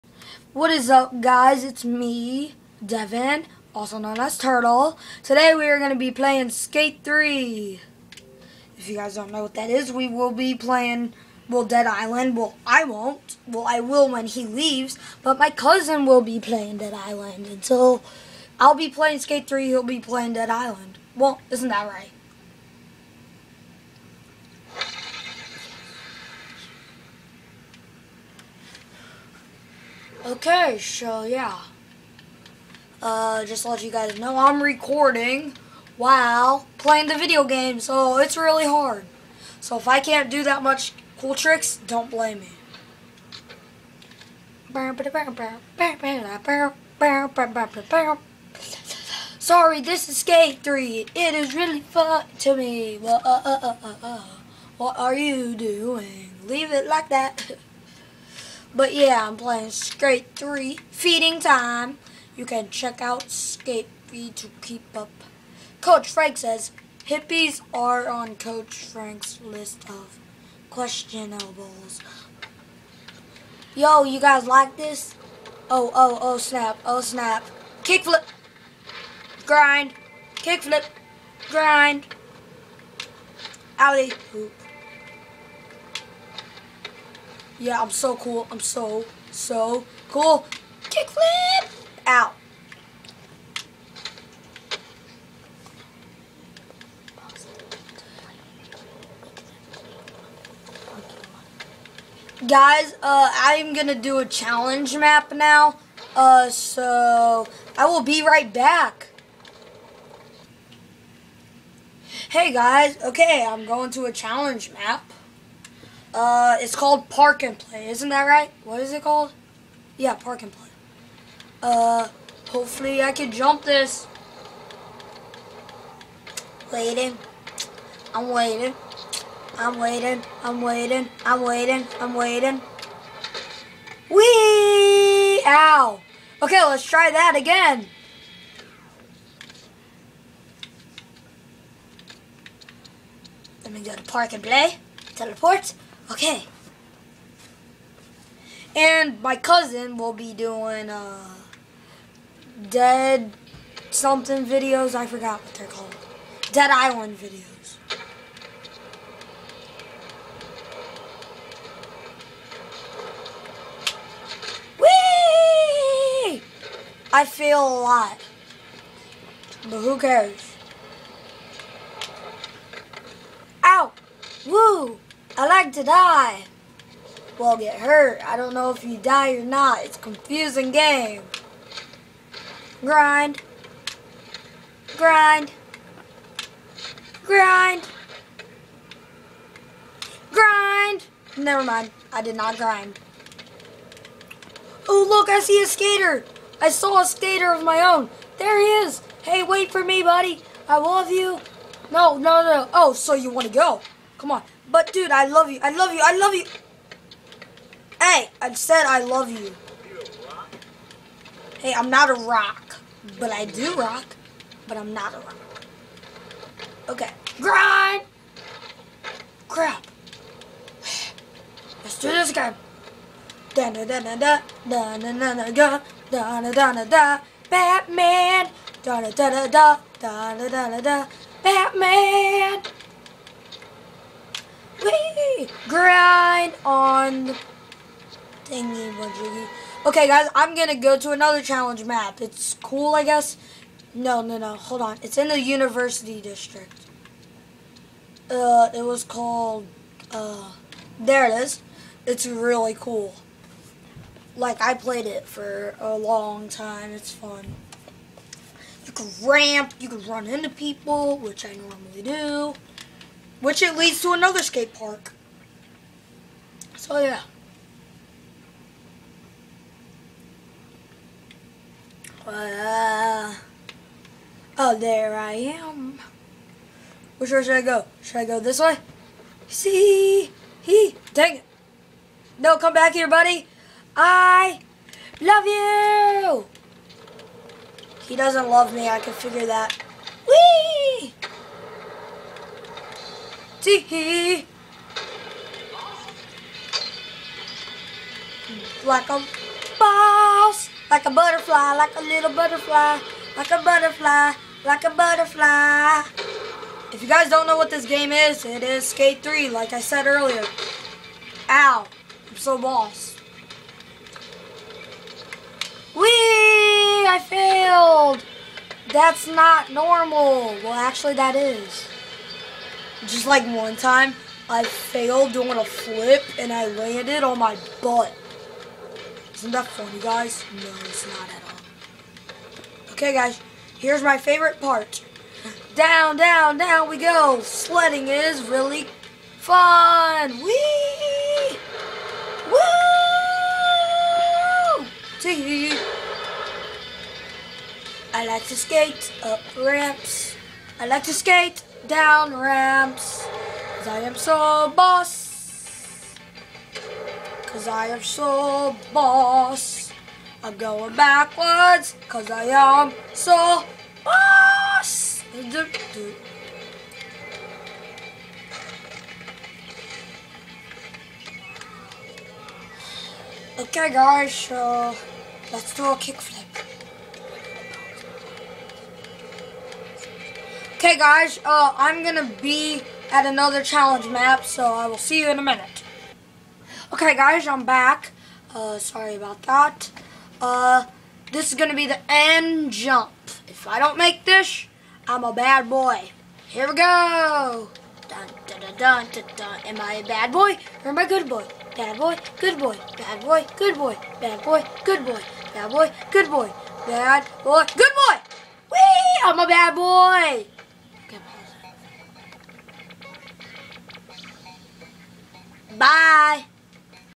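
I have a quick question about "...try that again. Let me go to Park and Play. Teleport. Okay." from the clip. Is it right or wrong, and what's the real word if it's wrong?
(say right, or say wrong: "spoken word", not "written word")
right.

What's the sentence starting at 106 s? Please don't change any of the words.
Uh, so I will be right back.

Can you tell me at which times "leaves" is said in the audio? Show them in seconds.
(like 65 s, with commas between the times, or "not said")
14 s, 56 s.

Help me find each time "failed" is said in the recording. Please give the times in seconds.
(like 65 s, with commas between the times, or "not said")
317 s, 324 s.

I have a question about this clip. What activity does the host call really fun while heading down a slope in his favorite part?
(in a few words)
Sledding.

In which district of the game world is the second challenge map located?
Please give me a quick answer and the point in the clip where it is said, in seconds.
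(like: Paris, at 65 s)
university district, at 245 s.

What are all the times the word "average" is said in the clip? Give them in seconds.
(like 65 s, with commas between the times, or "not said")
not said.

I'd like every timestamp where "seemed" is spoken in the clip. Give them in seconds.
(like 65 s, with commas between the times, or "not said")
not said.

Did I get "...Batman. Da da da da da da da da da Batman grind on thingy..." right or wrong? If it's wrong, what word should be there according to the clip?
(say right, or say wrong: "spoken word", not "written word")
right.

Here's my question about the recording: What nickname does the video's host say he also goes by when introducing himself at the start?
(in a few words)
Turtle.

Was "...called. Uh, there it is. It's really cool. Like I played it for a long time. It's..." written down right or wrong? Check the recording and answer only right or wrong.
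right.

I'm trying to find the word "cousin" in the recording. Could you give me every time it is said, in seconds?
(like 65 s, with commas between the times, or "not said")
15 s, 149 s.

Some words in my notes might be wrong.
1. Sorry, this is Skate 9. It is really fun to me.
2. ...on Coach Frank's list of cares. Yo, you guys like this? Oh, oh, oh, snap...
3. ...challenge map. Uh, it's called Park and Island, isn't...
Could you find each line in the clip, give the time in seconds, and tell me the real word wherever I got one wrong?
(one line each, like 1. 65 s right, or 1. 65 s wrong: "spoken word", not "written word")
1. 49 s wrong: "3", not "9"
2. 68 s wrong: "questionables", not "cares"
3. 114 s wrong: "Play", not "Island".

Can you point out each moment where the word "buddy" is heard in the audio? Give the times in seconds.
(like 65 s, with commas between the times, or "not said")
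200 s, 283 s.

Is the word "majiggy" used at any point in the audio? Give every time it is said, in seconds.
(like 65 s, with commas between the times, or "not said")
238 s.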